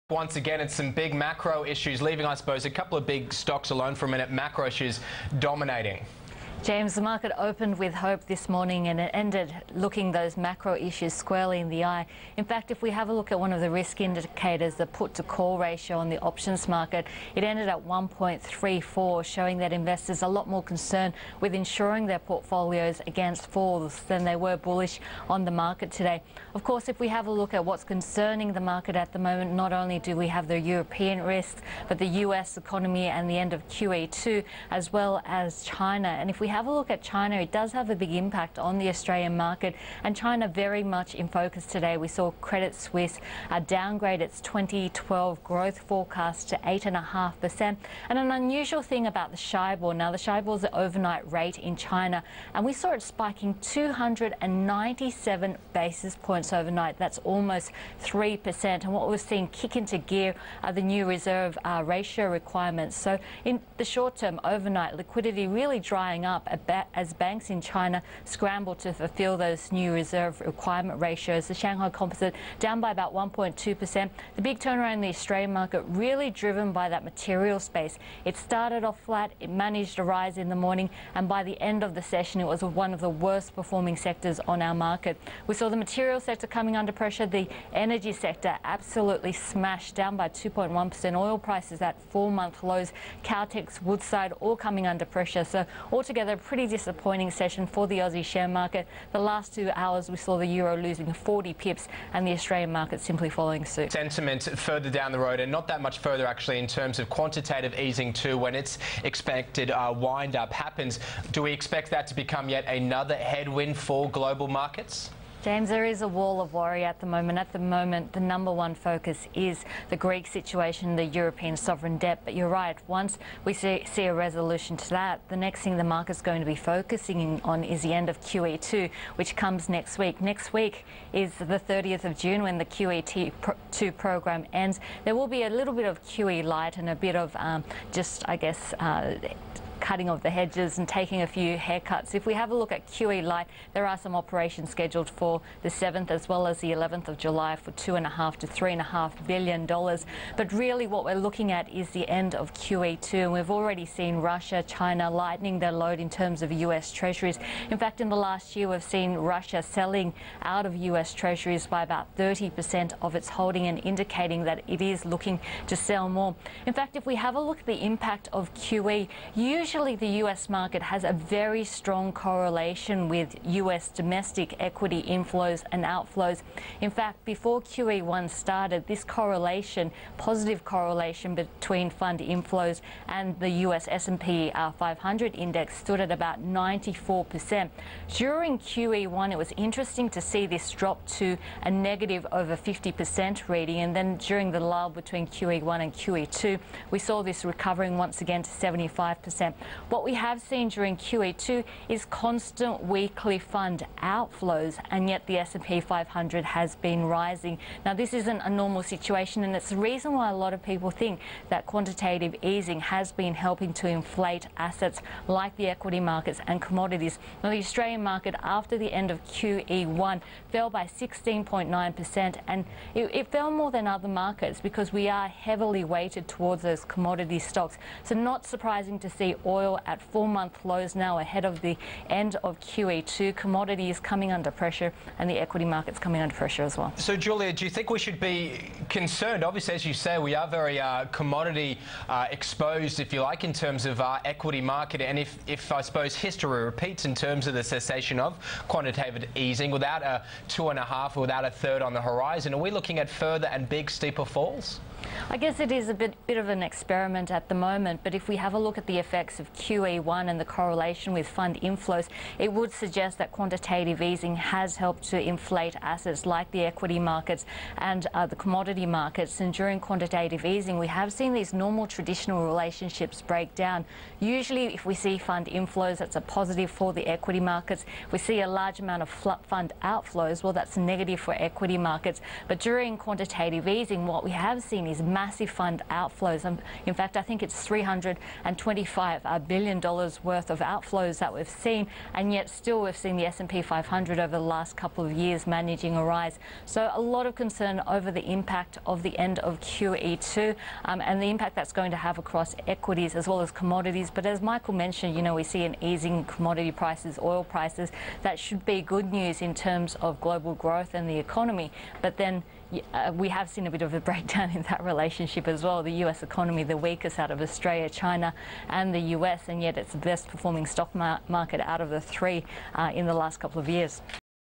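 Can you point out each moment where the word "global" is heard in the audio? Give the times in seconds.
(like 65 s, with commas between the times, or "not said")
114 s, 310 s.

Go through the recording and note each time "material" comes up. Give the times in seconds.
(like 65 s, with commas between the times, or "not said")
77 s, 85 s.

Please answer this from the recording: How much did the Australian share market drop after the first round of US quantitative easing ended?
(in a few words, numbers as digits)
16.9%.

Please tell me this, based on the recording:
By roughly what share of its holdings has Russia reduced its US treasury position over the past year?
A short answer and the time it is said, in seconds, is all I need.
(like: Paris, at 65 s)
30%, at 162 s.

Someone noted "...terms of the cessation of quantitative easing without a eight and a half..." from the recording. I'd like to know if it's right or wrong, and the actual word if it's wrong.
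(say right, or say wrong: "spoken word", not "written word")
wrong: "two", not "eight".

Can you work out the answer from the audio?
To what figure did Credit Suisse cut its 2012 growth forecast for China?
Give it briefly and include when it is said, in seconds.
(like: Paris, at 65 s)
8.5%, at 46 s.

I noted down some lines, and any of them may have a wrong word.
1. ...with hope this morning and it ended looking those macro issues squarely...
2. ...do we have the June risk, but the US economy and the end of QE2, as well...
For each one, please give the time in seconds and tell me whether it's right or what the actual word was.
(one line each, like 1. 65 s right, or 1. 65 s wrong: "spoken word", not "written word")
1. 7 s right
2. 29 s wrong: "European", not "June".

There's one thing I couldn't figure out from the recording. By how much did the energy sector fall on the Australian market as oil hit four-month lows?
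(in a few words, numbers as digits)
2.1%.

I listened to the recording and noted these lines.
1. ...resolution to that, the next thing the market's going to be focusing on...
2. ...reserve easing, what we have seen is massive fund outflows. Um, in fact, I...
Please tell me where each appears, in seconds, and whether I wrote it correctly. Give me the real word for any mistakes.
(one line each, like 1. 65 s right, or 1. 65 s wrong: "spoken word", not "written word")
1. 124 s right
2. 282 s wrong: "quantitative", not "reserve".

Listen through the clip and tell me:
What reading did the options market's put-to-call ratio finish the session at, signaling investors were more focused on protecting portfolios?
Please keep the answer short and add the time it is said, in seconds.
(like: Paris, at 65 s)
1.34, at 17 s.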